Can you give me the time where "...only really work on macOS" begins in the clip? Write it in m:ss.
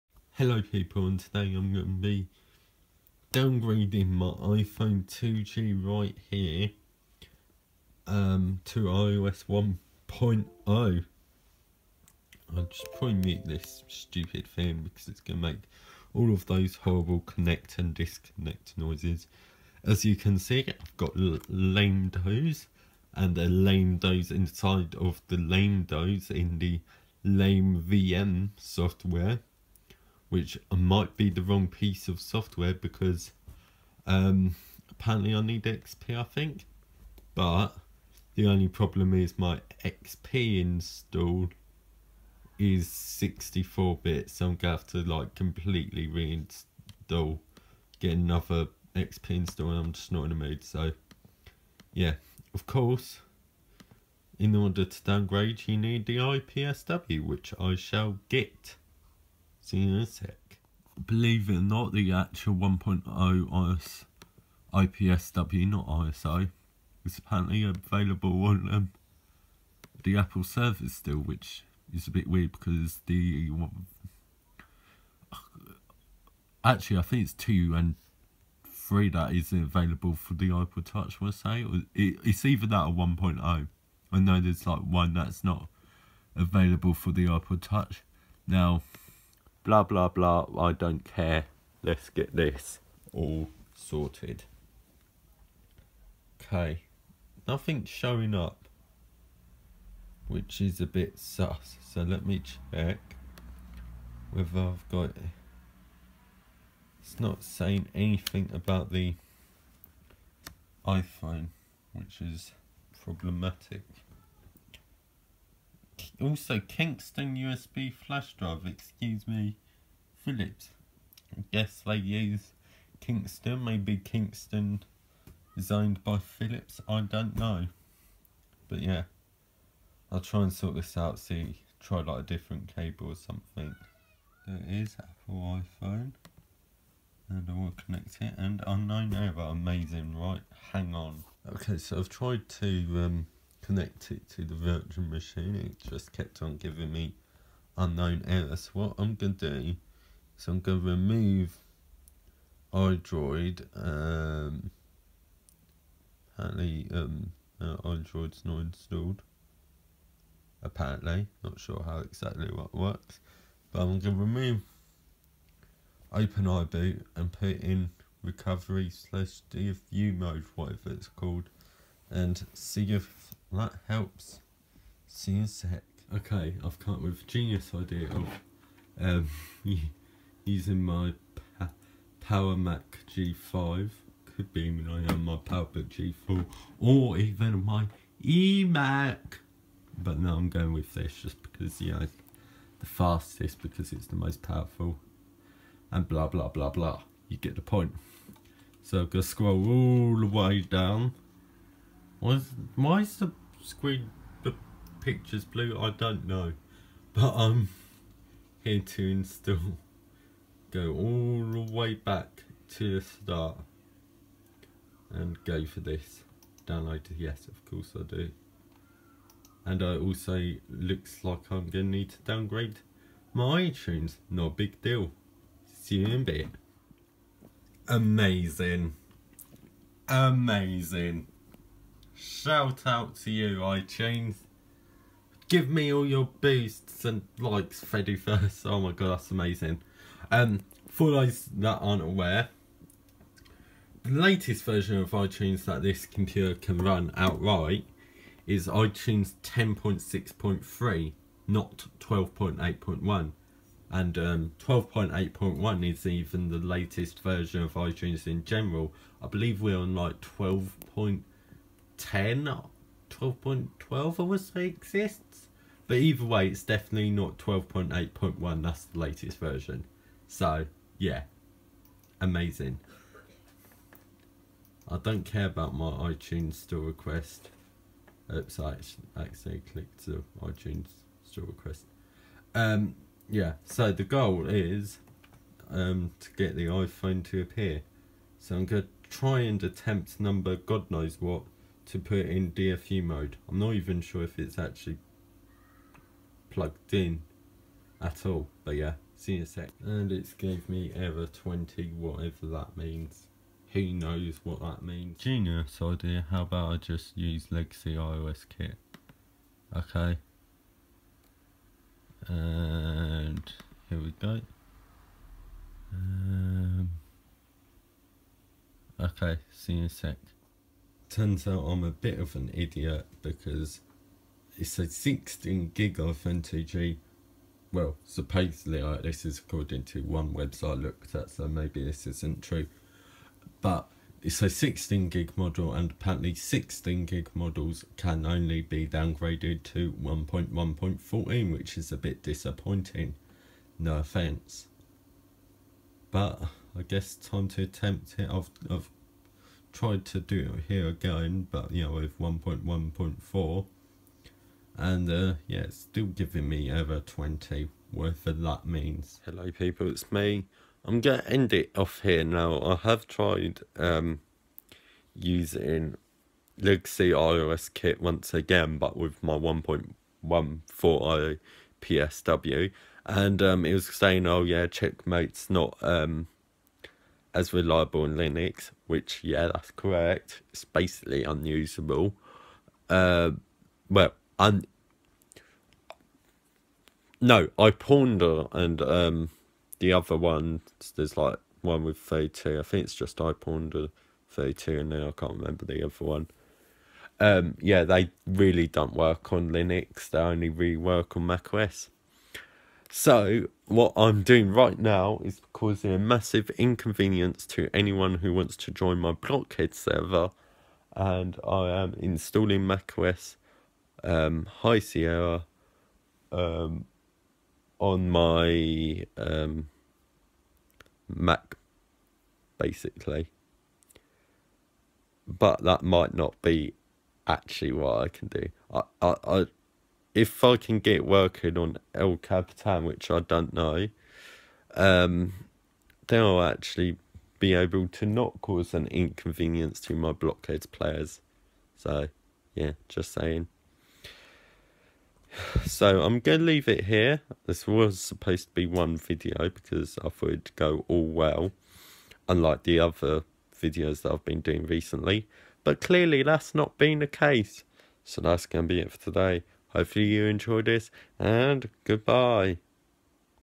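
6:40.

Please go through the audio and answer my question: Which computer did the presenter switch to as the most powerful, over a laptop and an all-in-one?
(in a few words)
Power Mac G5.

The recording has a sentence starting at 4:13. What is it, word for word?
And 12.8.1 um, is even the latest version of iTunes in general.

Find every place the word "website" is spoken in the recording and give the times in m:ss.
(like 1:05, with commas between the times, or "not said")
5:30.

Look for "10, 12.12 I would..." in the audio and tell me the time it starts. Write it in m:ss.
4:22.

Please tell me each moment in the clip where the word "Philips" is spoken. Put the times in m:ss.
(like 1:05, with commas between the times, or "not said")
2:00, 2:06.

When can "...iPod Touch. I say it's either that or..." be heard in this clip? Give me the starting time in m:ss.
1:20.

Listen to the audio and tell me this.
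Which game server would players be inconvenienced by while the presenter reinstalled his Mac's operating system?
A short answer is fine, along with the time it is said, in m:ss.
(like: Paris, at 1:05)
Blockheads, at 6:49.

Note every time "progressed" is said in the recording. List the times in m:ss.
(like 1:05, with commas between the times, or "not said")
not said.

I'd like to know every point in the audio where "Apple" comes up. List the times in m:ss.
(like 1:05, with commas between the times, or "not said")
1:10, 2:14.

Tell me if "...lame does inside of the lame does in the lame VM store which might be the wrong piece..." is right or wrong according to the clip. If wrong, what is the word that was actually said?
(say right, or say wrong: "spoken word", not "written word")
wrong: "software", not "store".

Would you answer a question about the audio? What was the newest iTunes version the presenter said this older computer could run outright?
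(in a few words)
10.6.3.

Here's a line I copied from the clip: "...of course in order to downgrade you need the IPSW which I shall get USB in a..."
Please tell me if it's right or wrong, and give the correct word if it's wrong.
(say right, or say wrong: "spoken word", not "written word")
wrong: "See", not "USB".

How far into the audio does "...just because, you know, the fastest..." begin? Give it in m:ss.
3:11.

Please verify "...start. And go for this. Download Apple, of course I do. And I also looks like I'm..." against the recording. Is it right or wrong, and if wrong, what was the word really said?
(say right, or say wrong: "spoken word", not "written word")
wrong: "Yes", not "Apple".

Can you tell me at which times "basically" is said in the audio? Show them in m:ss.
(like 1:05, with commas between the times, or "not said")
6:20, 7:02.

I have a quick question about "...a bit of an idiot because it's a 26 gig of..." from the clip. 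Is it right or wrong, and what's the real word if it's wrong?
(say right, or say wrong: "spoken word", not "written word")
wrong: "16", not "26".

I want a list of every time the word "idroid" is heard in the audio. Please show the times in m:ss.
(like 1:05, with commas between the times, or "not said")
2:32, 2:37.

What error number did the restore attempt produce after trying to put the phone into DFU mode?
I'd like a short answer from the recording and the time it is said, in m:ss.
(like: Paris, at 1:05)
20, at 5:00.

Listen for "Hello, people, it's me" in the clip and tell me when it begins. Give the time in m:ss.
5:59.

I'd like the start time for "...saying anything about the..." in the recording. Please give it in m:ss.
1:47.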